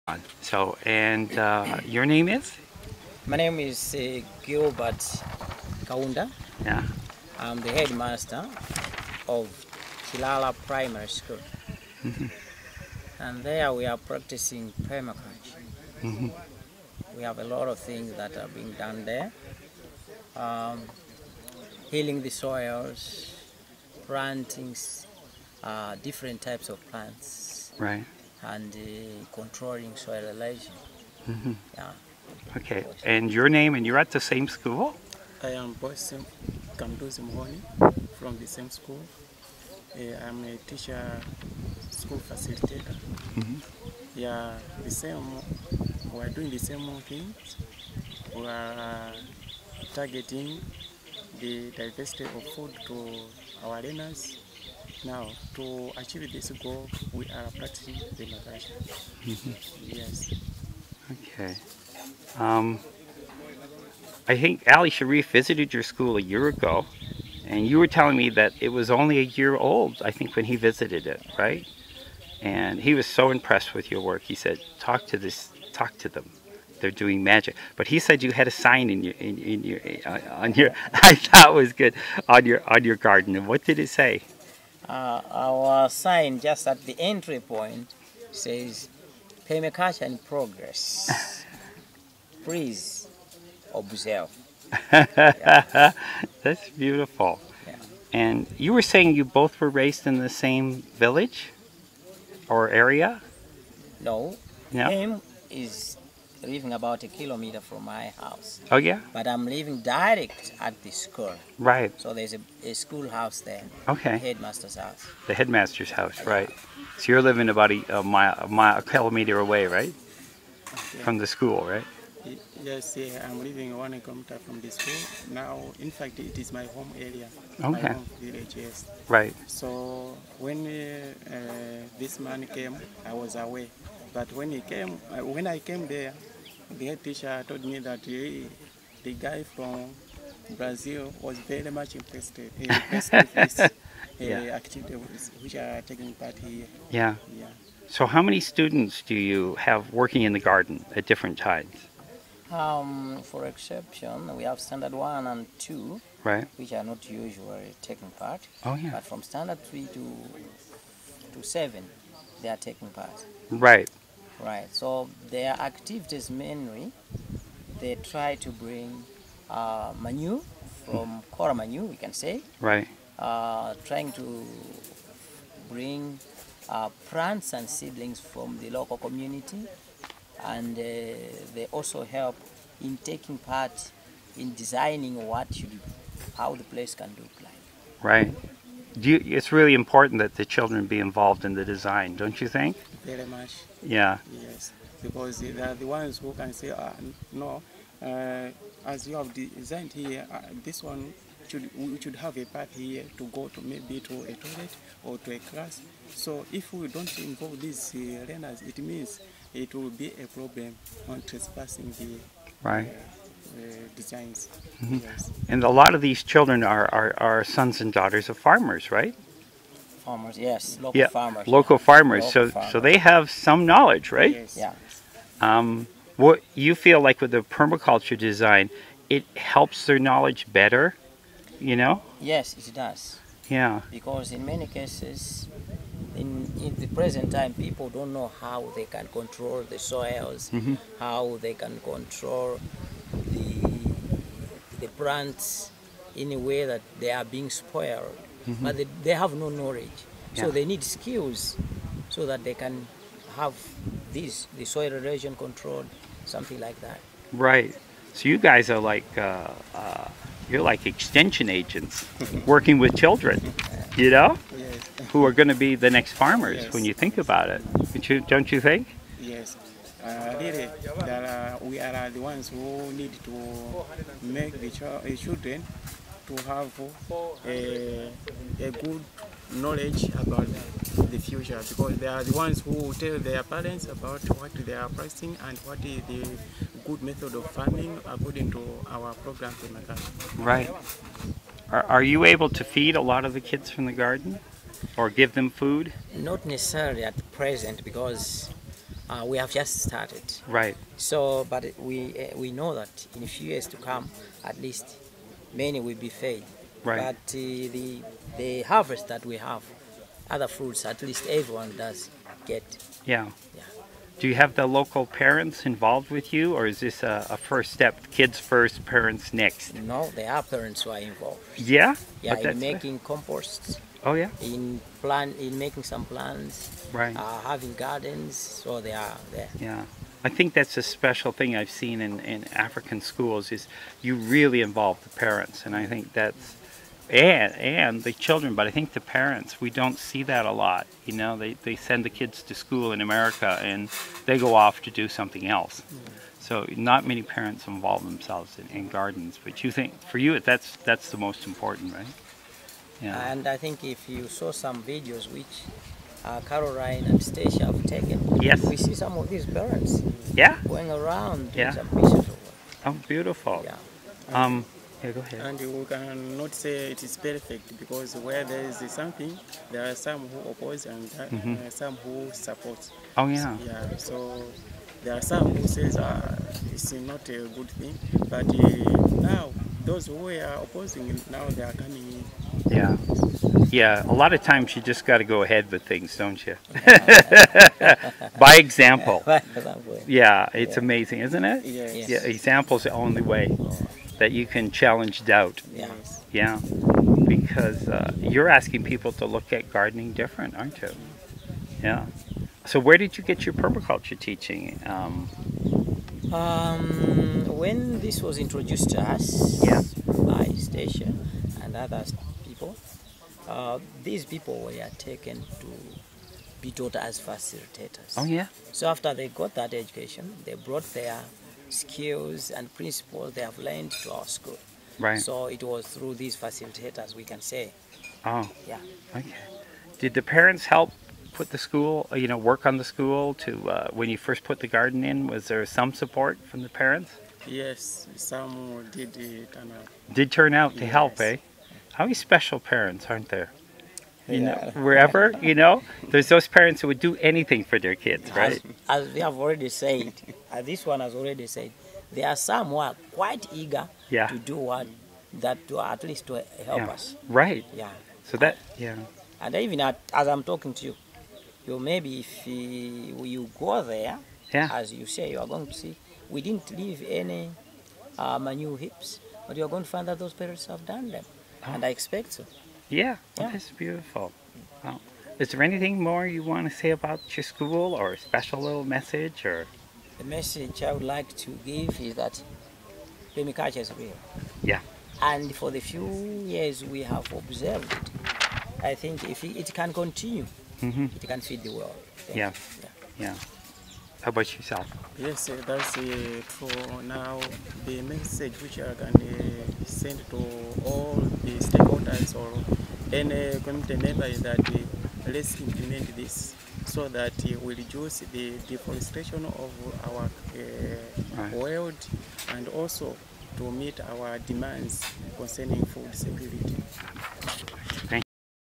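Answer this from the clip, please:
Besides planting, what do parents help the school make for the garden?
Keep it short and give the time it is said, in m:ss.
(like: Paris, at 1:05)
Composts, at 5:23.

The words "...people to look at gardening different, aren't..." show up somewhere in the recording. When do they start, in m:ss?
6:38.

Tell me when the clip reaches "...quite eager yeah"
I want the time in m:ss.
7:33.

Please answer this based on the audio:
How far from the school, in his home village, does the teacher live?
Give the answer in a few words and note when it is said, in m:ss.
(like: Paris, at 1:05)
1 kilometer, at 2:03.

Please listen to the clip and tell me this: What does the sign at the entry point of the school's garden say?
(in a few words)
Permaculture in progress.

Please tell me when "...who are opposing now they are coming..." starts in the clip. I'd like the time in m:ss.
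6:20.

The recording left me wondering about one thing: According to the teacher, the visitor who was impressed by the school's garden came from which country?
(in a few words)
Brazil.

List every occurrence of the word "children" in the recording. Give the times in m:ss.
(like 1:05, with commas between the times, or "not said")
3:10, 3:36, 4:22, 4:35, 5:38.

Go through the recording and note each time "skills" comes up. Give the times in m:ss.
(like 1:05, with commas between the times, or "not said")
4:10, 7:01.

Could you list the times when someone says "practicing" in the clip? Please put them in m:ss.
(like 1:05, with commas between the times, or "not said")
0:13, 0:57, 4:44.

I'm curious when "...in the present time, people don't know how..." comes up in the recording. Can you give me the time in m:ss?
3:56.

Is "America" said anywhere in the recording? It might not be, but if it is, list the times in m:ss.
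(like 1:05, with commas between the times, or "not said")
5:43.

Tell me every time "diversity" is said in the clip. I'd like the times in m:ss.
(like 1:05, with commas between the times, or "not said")
0:51.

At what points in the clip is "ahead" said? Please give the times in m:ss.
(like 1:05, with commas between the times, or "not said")
6:05, 6:25.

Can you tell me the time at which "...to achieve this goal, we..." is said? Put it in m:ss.
0:55.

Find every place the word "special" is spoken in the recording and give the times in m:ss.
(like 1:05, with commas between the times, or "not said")
5:30, 7:22, 7:58.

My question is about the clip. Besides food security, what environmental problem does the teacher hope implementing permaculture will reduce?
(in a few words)
Deforestation.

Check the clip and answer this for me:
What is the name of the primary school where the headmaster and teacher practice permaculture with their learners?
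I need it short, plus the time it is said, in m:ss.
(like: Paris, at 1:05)
Kilala Primary School, at 0:10.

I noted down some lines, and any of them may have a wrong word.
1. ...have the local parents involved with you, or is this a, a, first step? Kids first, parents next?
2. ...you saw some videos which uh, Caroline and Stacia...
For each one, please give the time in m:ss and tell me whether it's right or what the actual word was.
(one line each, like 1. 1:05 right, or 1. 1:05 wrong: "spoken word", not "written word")
1. 5:14 right
2. 5:54 right.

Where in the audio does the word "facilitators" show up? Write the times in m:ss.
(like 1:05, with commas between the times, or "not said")
0:42, 6:57, 7:06.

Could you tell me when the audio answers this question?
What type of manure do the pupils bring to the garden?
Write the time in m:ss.
2:51.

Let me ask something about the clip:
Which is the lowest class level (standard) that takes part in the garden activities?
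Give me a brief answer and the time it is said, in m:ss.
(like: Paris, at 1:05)
Standard 3, at 2:39.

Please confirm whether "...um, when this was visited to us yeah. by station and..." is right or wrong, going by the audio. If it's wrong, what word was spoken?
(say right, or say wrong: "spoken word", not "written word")
wrong: "introduced", not "visited".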